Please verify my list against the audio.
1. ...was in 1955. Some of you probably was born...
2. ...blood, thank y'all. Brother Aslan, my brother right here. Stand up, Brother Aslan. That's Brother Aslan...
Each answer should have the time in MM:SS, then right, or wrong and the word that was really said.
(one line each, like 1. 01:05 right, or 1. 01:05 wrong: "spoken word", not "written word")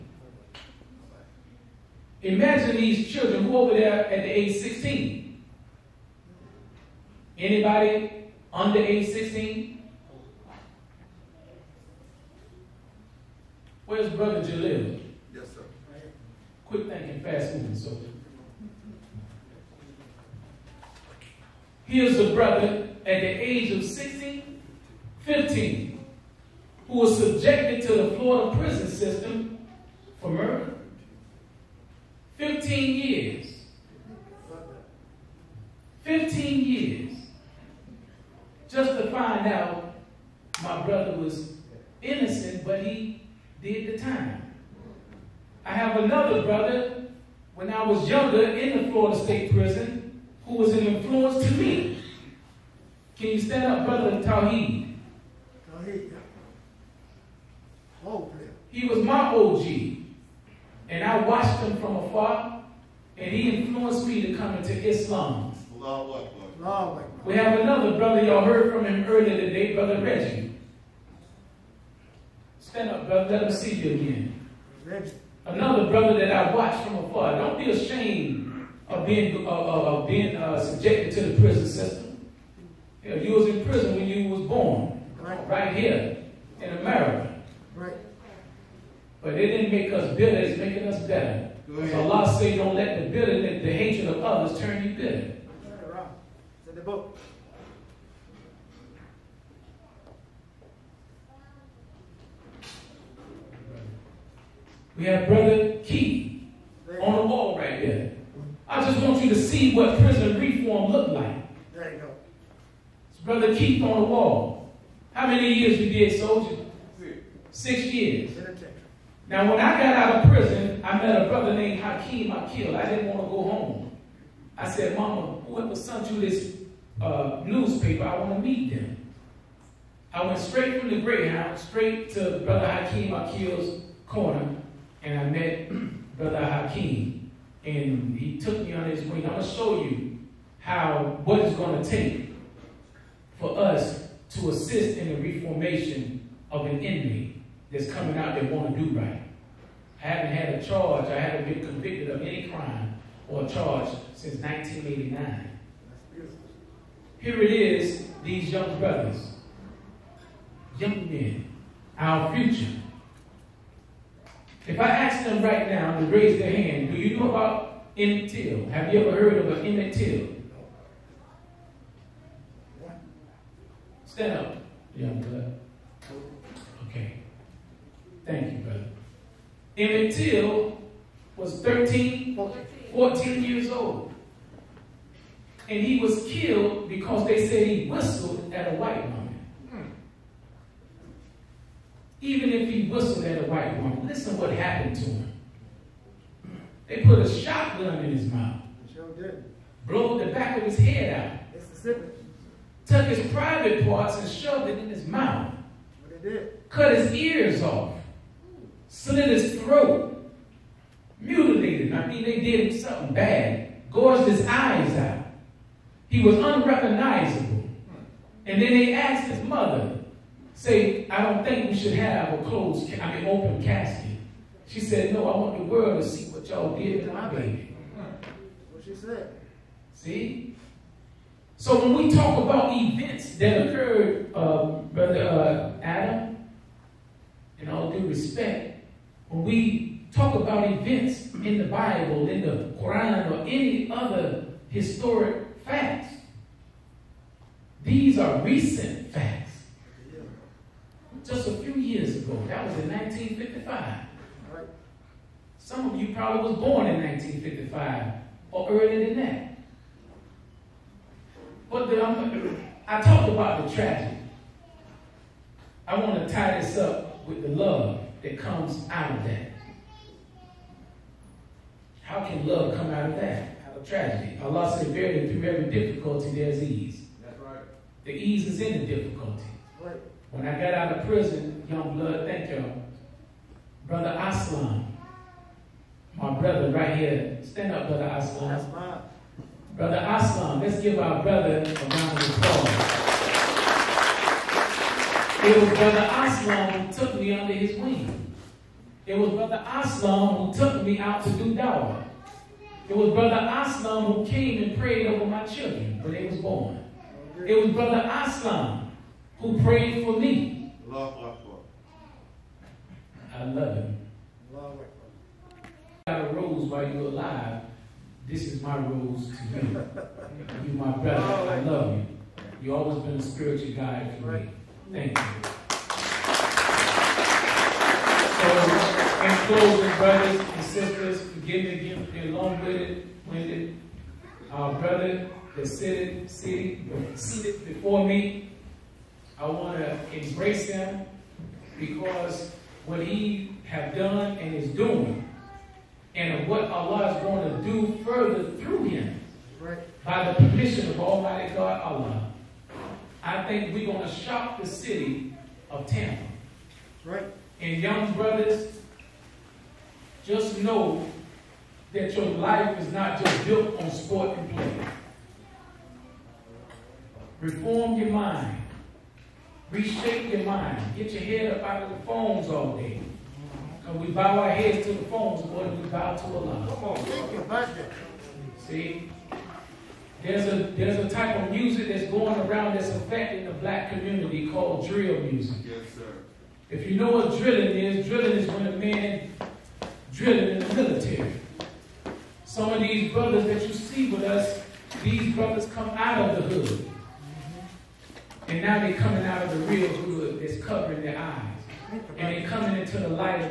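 1. 04:12 right
2. 04:41 right.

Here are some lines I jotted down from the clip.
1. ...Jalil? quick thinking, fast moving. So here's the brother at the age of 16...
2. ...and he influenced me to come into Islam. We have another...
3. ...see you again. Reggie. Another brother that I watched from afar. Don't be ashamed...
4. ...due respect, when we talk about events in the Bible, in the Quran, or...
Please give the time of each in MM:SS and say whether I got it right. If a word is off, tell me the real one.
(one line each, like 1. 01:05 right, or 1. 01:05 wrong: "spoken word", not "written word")
1. 00:14 right
2. 01:03 right
3. 01:13 right
4. 03:57 right.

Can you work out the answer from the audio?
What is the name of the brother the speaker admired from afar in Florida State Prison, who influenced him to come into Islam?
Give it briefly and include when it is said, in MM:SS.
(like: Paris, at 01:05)
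Tawheed, at 00:55.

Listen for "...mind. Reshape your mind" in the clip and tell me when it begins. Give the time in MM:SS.
06:08.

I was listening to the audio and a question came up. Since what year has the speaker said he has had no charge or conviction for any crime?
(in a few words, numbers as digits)
1989.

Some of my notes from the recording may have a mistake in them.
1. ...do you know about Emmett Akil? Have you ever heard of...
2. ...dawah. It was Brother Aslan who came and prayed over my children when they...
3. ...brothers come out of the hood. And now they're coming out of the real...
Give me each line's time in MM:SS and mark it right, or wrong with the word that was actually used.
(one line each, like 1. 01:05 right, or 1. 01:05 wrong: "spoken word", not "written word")
1. 02:46 wrong: "Till", not "Akil"
2. 05:01 right
3. 06:35 right.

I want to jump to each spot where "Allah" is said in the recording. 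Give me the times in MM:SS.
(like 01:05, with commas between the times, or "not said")
01:32, 04:34, 05:46, 05:51, 06:16.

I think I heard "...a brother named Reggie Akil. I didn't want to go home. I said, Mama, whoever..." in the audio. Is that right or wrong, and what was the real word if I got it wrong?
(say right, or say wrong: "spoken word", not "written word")
wrong: "Hakeem", not "Reggie".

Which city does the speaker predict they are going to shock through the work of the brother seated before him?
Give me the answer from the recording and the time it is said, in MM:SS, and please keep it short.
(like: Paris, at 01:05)
Tampa, at 05:54.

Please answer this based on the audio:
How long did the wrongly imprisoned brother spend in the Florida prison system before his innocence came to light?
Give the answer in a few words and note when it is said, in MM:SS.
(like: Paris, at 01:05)
15 years, at 00:36.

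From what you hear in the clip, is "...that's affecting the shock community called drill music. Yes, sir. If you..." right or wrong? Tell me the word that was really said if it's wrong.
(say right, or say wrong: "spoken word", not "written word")
wrong: "black", not "shock".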